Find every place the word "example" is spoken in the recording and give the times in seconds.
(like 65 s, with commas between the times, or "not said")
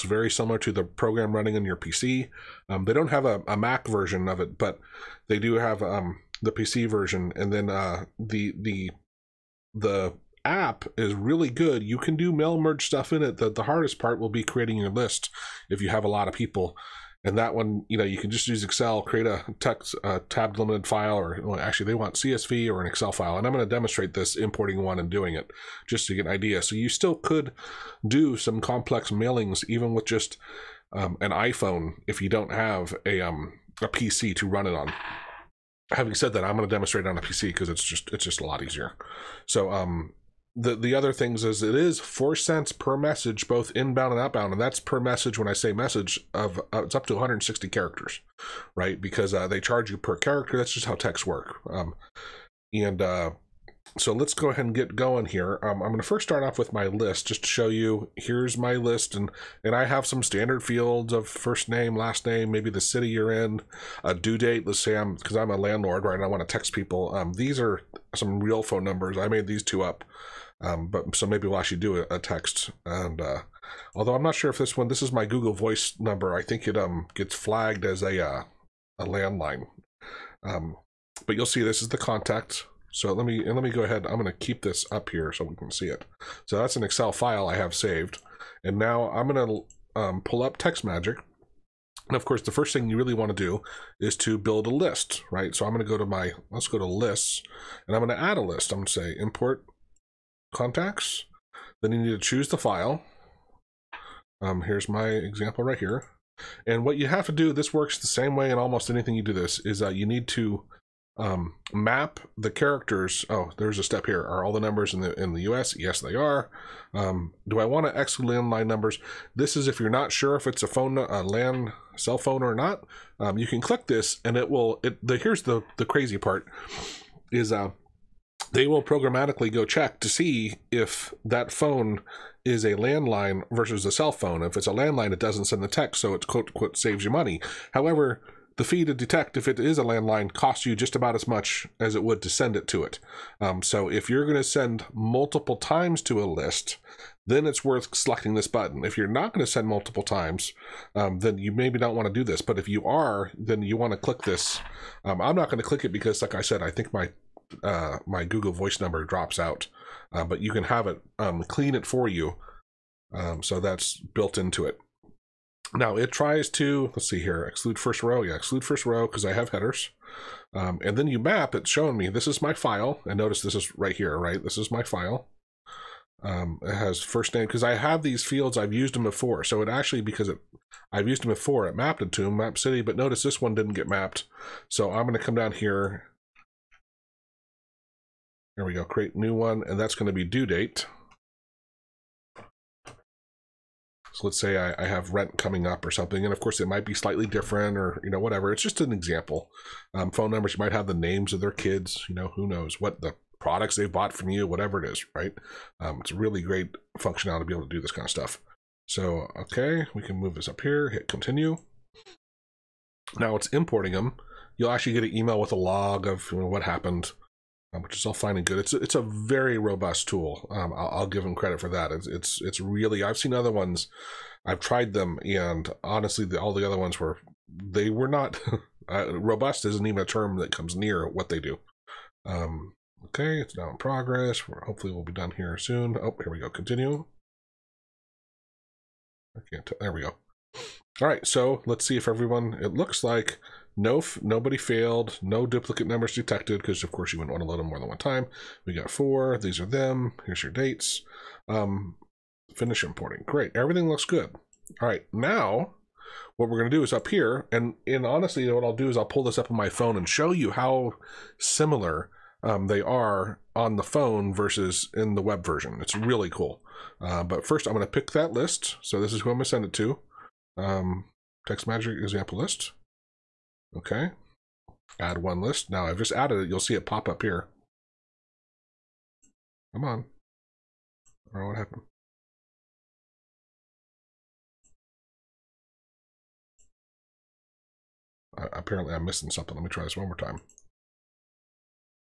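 105 s, 198 s, 271 s.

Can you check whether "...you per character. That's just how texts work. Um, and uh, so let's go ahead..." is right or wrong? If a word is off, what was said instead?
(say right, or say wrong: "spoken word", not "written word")
right.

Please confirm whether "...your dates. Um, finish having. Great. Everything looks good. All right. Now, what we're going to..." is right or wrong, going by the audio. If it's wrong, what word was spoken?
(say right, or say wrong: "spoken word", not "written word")
wrong: "importing", not "having".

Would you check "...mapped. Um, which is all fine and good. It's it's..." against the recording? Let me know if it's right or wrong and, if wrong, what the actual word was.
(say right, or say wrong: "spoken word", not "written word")
wrong: "happened", not "mapped".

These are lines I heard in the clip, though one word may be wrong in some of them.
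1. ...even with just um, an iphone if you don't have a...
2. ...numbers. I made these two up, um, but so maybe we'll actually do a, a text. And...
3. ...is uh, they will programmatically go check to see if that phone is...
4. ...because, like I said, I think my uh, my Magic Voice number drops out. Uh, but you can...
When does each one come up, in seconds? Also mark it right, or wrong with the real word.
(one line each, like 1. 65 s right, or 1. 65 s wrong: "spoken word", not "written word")
1. 29 s right
2. 68 s right
3. 127 s right
4. 155 s wrong: "Google", not "Magic".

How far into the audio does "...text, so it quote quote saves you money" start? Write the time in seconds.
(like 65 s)
135 s.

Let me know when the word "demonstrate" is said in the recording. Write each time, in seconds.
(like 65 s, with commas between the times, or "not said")
23 s, 36 s.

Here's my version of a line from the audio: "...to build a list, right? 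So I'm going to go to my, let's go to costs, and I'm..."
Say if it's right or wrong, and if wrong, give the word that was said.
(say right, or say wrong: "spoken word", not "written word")
wrong: "lists", not "costs".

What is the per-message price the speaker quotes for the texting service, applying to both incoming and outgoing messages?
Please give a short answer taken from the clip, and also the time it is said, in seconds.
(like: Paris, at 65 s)
4 cents, at 41 s.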